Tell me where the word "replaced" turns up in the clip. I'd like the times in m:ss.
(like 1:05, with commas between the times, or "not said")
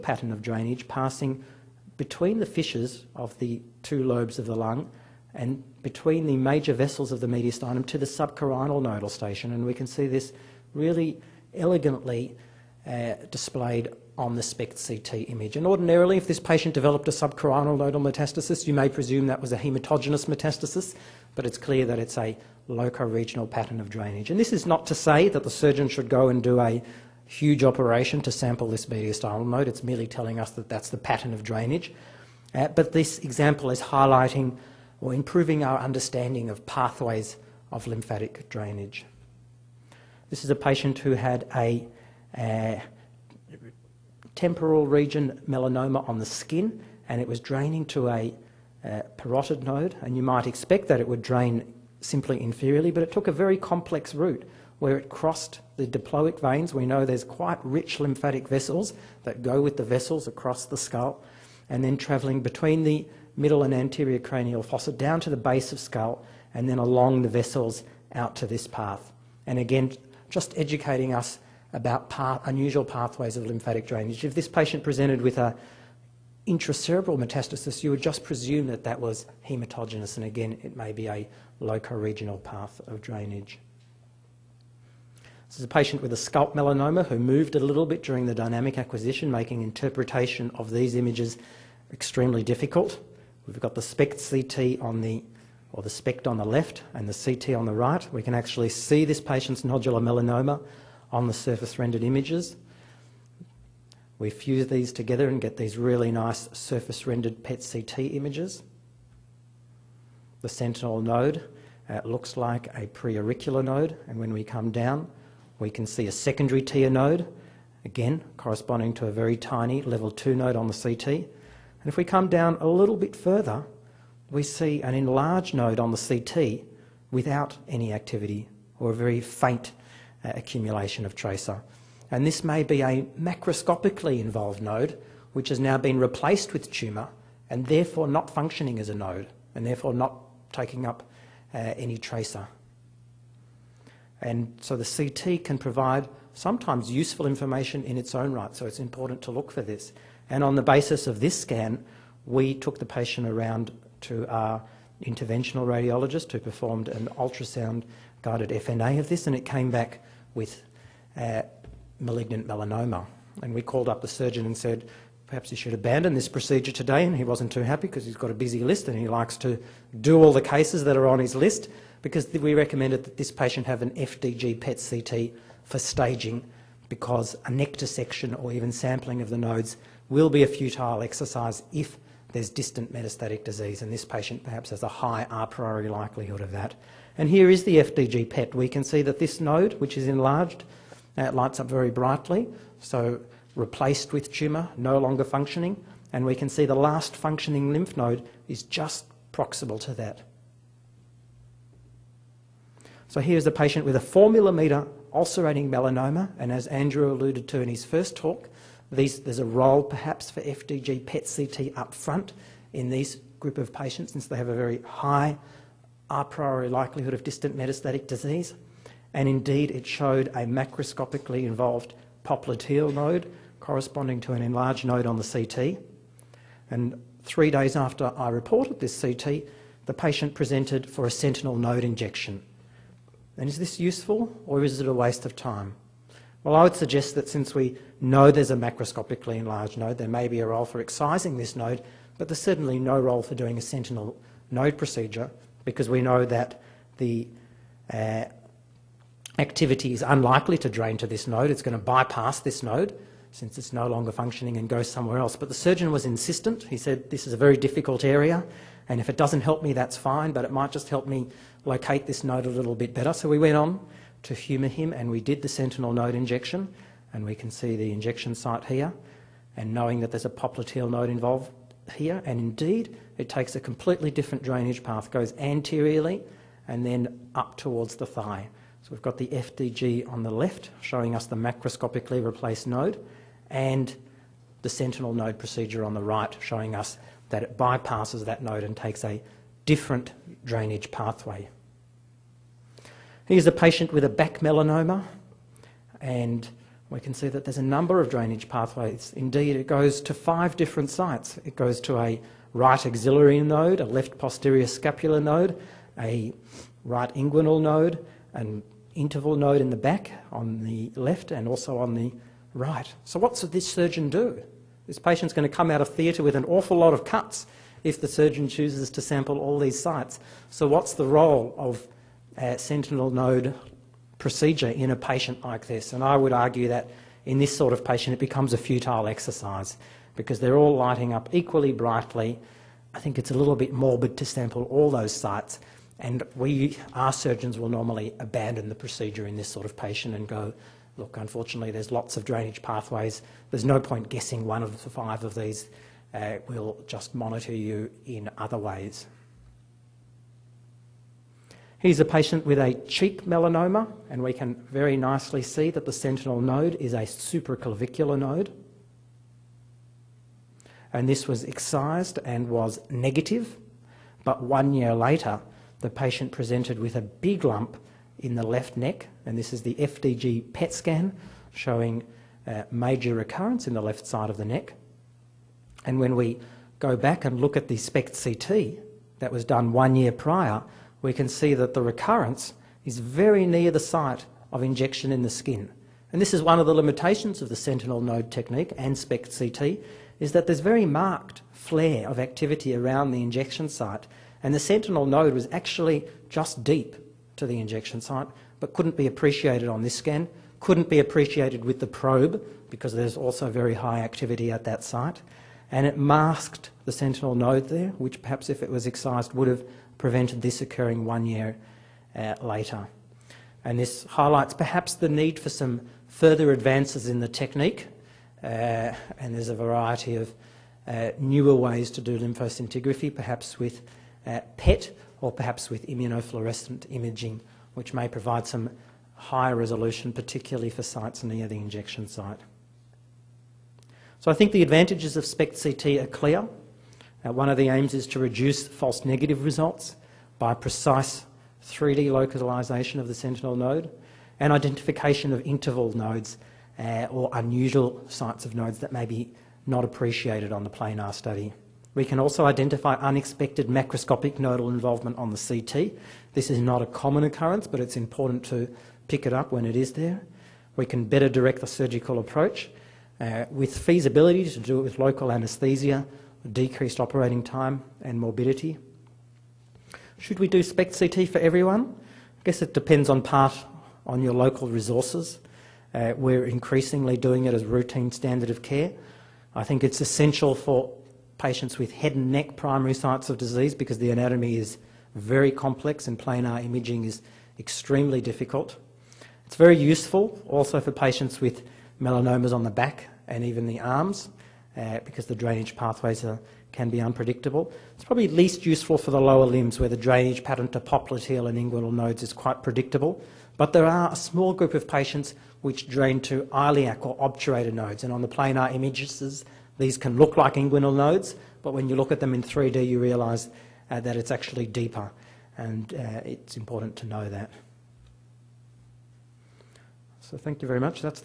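2:15, 3:13, 4:42.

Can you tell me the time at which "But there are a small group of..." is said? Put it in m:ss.
8:23.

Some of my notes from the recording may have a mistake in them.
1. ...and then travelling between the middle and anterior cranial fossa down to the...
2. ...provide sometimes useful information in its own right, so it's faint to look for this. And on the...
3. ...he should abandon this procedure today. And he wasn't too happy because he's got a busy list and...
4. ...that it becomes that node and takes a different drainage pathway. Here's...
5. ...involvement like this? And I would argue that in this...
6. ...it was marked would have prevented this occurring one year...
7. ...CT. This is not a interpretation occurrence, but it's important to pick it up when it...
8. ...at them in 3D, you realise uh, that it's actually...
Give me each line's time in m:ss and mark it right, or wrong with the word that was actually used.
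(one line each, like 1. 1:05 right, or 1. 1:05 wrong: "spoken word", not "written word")
1. 1:01 right
2. 2:25 wrong: "important", not "faint"
3. 2:45 right
4. 4:47 wrong: "bypasses", not "becomes"
5. 5:24 wrong: "patient", not "involvement"
6. 6:48 wrong: "excised", not "marked"
7. 7:35 wrong: "common", not "interpretation"
8. 8:32 right.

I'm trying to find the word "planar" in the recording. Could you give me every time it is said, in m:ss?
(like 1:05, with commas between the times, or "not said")
7:30, 8:06, 8:28.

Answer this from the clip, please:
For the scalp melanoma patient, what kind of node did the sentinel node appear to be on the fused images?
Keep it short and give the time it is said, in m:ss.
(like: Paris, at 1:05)
Preauricular node, at 1:52.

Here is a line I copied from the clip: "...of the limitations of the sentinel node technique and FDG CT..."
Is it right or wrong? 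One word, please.
wrong.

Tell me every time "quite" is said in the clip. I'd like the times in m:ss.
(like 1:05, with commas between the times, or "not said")
0:57, 8:22.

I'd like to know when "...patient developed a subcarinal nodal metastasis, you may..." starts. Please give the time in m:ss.
0:16.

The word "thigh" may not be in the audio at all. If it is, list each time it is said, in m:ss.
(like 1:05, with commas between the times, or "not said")
4:38.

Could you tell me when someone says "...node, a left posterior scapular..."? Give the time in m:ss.
5:03.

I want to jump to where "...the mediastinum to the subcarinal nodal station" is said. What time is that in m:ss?
0:07.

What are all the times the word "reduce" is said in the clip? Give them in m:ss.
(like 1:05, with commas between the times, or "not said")
7:18.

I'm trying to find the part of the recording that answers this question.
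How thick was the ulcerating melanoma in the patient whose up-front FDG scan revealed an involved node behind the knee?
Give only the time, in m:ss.
3:23.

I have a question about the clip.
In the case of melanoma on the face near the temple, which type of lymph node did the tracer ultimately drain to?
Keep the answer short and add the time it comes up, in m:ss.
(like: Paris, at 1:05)
Parotid node, at 0:49.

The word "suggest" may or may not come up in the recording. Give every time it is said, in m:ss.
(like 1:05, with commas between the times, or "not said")
3:56.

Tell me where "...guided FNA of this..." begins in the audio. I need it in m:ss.
2:38.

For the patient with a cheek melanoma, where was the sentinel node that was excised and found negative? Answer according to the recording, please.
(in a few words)
Supraclavicular.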